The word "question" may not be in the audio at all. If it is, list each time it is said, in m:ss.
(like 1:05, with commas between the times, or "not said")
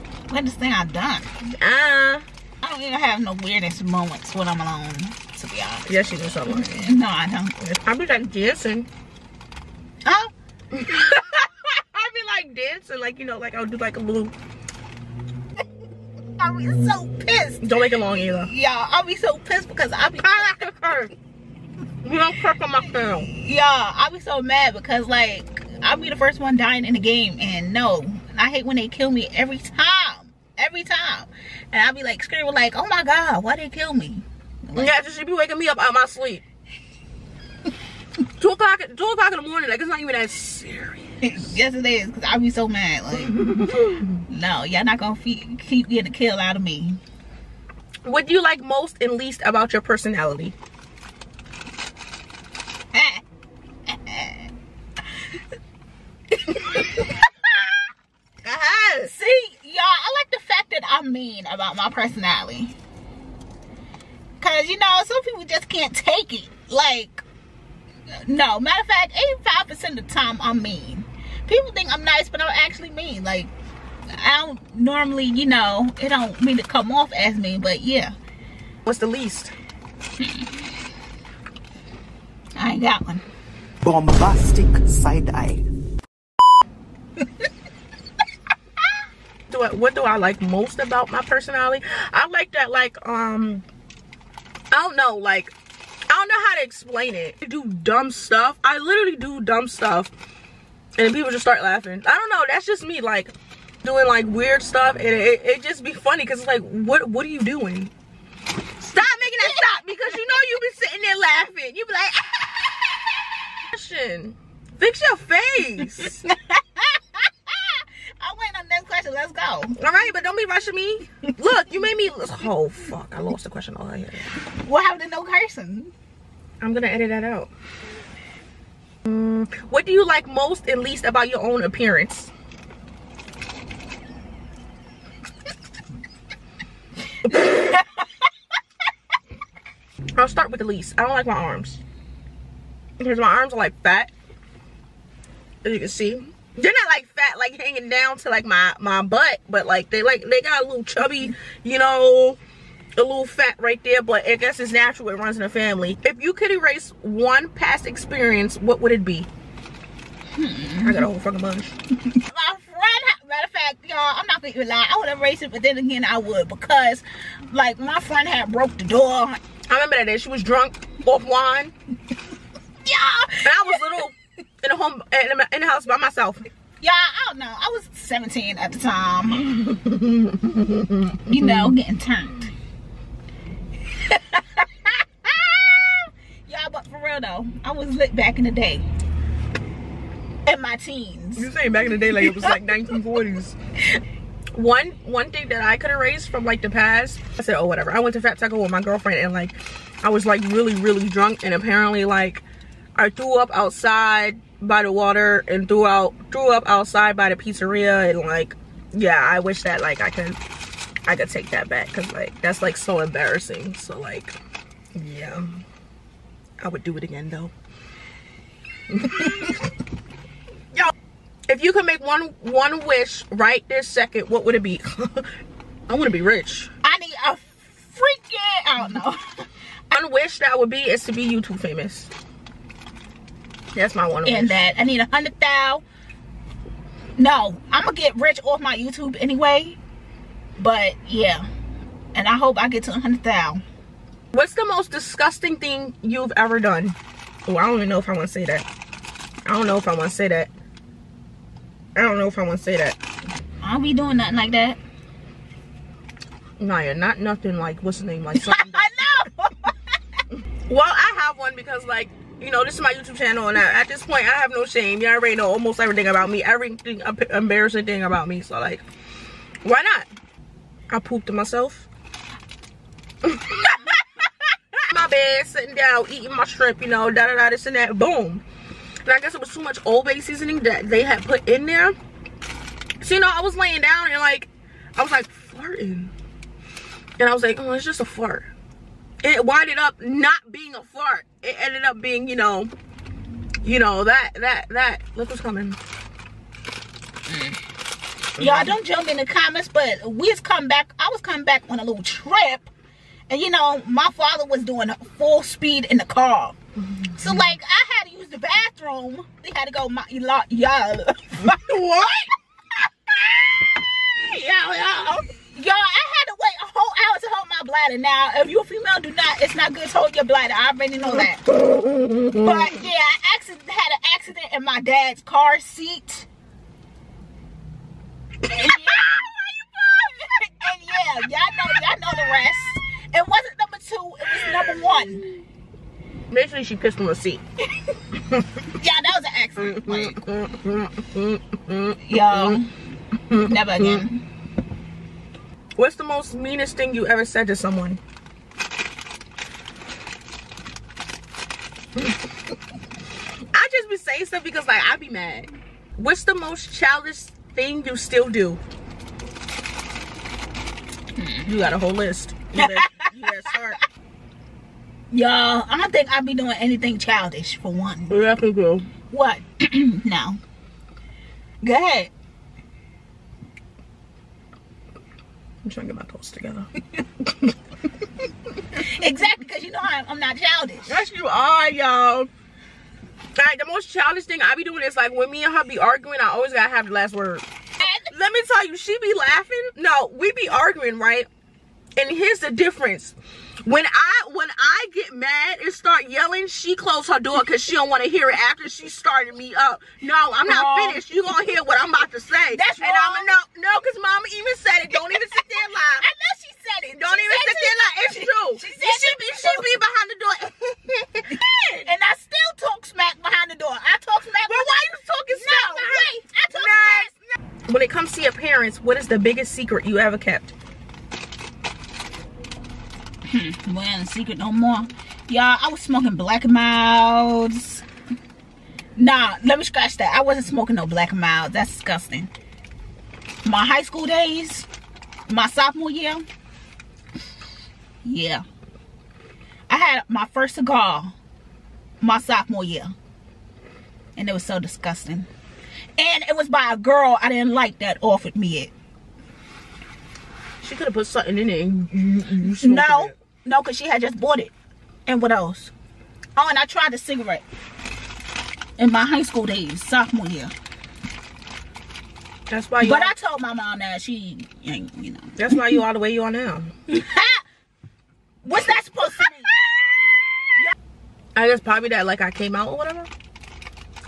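1:53, 1:58, 2:03.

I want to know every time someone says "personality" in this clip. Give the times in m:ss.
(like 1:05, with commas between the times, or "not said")
0:49, 1:01, 1:31.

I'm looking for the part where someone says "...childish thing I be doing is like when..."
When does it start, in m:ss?
6:23.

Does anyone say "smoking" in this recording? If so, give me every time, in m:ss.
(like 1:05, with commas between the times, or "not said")
7:05, 7:10.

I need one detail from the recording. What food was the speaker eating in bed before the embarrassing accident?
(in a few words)
shrimp.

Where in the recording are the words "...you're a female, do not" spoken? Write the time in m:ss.
5:18.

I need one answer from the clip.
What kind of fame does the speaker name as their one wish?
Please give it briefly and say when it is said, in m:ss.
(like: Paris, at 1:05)
YouTube famous, at 3:51.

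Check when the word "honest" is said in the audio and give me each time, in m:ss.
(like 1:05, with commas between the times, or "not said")
0:05.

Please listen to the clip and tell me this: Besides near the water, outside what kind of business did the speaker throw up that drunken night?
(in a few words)
pizzeria.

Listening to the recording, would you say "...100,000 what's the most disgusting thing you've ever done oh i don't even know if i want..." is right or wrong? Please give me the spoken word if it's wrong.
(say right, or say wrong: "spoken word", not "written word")
right.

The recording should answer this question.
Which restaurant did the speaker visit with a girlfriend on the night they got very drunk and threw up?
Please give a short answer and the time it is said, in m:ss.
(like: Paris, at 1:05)
Fat Taco, at 3:18.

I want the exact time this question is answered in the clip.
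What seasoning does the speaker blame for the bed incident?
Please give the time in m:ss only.
4:39.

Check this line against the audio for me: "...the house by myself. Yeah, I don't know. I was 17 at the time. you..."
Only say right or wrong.
right.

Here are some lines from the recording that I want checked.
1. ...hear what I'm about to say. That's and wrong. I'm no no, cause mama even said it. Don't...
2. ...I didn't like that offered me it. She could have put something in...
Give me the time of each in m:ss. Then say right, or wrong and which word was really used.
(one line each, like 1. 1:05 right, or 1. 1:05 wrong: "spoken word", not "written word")
1. 6:41 right
2. 7:27 right.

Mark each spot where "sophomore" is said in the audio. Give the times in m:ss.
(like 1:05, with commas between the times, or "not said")
7:15, 7:22, 7:39.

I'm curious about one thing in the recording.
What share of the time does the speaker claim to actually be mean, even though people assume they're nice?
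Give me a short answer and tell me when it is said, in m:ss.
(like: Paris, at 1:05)
85%, at 1:09.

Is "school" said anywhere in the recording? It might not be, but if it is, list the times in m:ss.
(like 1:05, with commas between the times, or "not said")
7:13, 7:39.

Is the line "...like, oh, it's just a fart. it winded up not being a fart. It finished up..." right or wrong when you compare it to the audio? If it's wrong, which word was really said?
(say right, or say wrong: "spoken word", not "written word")
wrong: "ended", not "finished".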